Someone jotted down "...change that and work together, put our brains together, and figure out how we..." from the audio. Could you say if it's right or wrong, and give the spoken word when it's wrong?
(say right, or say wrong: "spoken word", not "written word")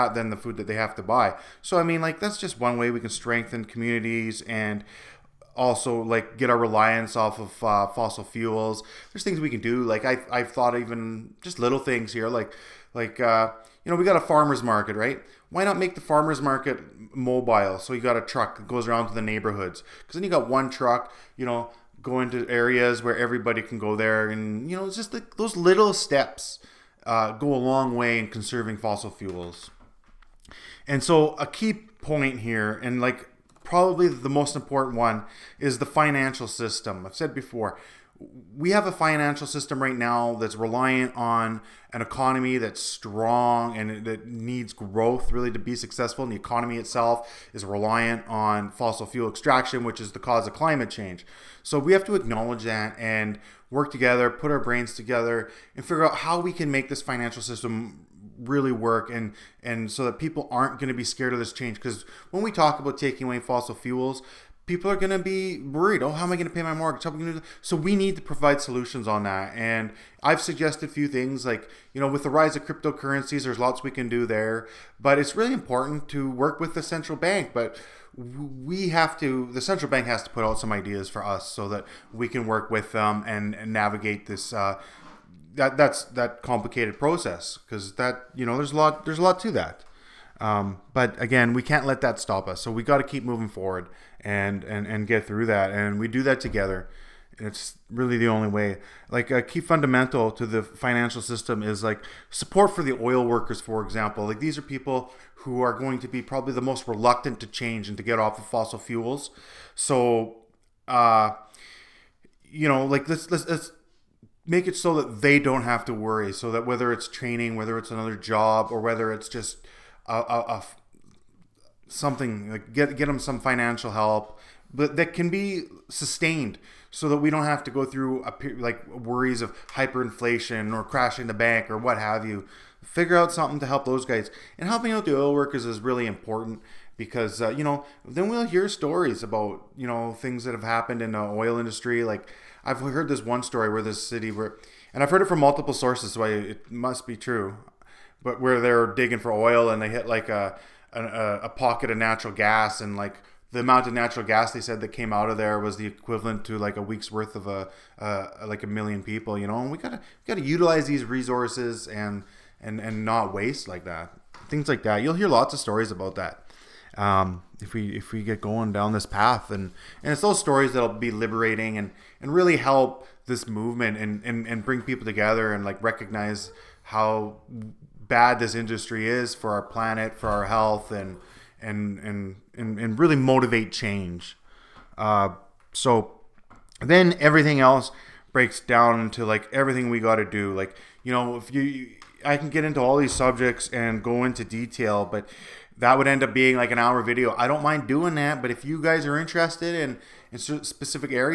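wrong: "acknowledge", not "change".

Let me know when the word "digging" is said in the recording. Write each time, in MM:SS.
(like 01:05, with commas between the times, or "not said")
02:28.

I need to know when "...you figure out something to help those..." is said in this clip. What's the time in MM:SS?
02:12.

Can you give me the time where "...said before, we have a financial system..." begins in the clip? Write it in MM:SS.
00:37.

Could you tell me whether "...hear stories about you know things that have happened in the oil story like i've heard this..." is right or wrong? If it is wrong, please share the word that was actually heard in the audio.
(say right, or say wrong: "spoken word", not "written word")
wrong: "industry", not "story".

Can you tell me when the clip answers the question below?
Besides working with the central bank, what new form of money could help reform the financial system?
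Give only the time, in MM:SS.
01:12.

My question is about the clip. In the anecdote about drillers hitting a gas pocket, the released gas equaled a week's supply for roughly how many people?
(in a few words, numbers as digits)
1,000,000.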